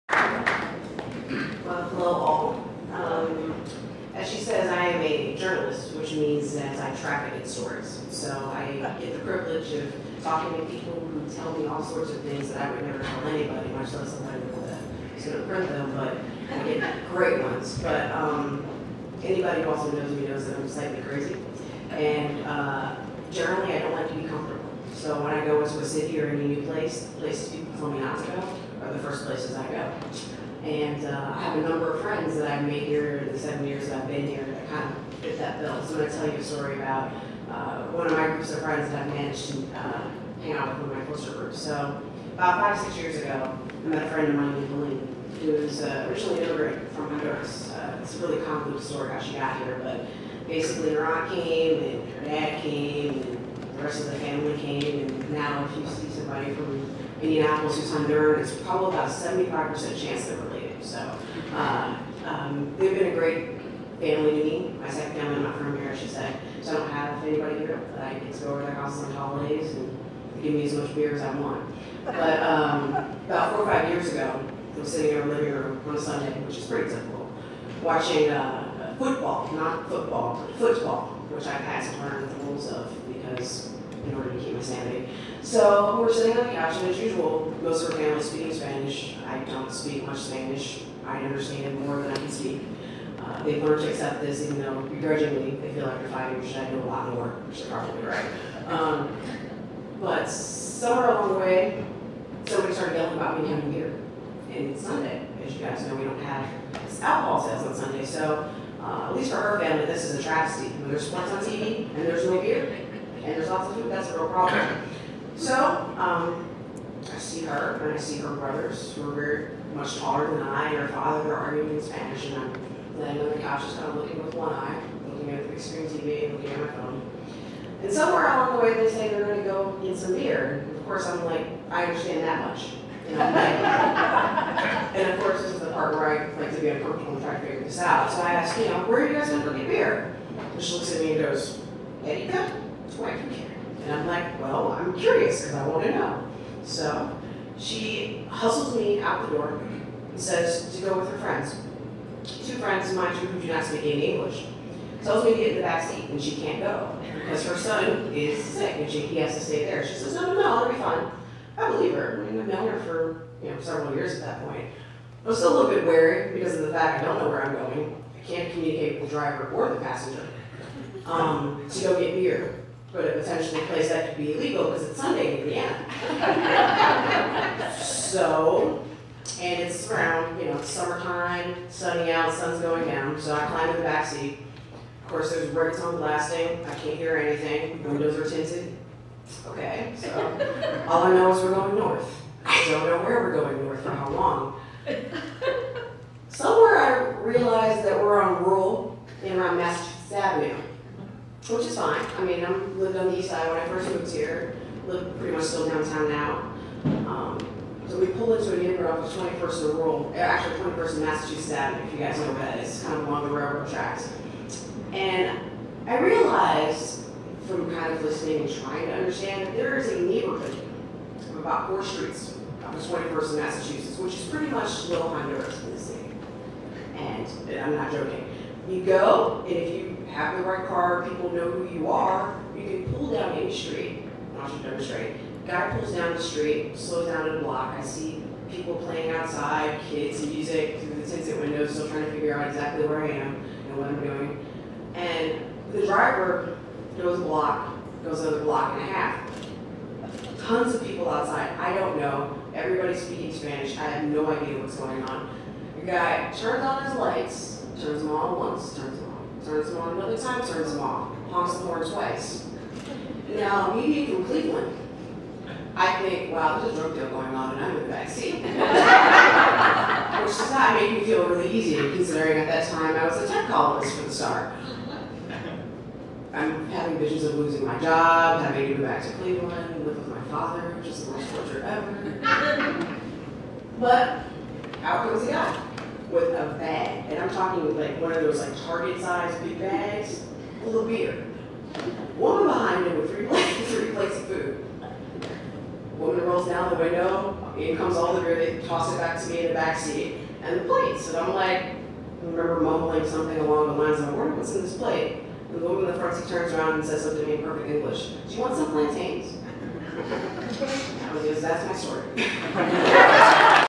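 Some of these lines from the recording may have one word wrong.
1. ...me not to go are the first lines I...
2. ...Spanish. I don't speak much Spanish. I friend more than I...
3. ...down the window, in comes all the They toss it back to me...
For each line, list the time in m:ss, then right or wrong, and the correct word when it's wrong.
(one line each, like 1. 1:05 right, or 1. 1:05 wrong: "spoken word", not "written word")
1. 0:27 wrong: "places", not "lines"
2. 1:28 wrong: "understand", not "friend"
3. 4:56 right.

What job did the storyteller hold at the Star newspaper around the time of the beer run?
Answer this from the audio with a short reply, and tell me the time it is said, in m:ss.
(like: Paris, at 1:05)
tech columnist, at 4:33.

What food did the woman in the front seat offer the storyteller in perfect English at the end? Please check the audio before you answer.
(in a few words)
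plantains.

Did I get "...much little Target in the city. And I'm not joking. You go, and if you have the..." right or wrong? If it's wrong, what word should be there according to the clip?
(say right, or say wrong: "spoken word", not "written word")
wrong: "Honduras", not "Target".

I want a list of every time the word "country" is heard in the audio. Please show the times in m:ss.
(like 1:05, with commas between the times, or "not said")
not said.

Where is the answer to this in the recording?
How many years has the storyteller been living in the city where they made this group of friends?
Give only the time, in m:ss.
0:33.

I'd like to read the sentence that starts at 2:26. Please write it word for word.
So she hustles me out the door and says to go with her friends.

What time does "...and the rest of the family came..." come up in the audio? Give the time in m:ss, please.
0:53.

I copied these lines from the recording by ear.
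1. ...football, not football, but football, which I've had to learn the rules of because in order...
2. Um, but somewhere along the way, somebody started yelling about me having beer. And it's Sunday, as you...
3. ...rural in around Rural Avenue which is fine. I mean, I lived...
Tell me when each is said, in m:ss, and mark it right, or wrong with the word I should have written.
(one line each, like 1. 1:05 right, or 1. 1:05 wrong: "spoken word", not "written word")
1. 1:18 right
2. 1:38 right
3. 3:18 wrong: "Massachusetts", not "Rural".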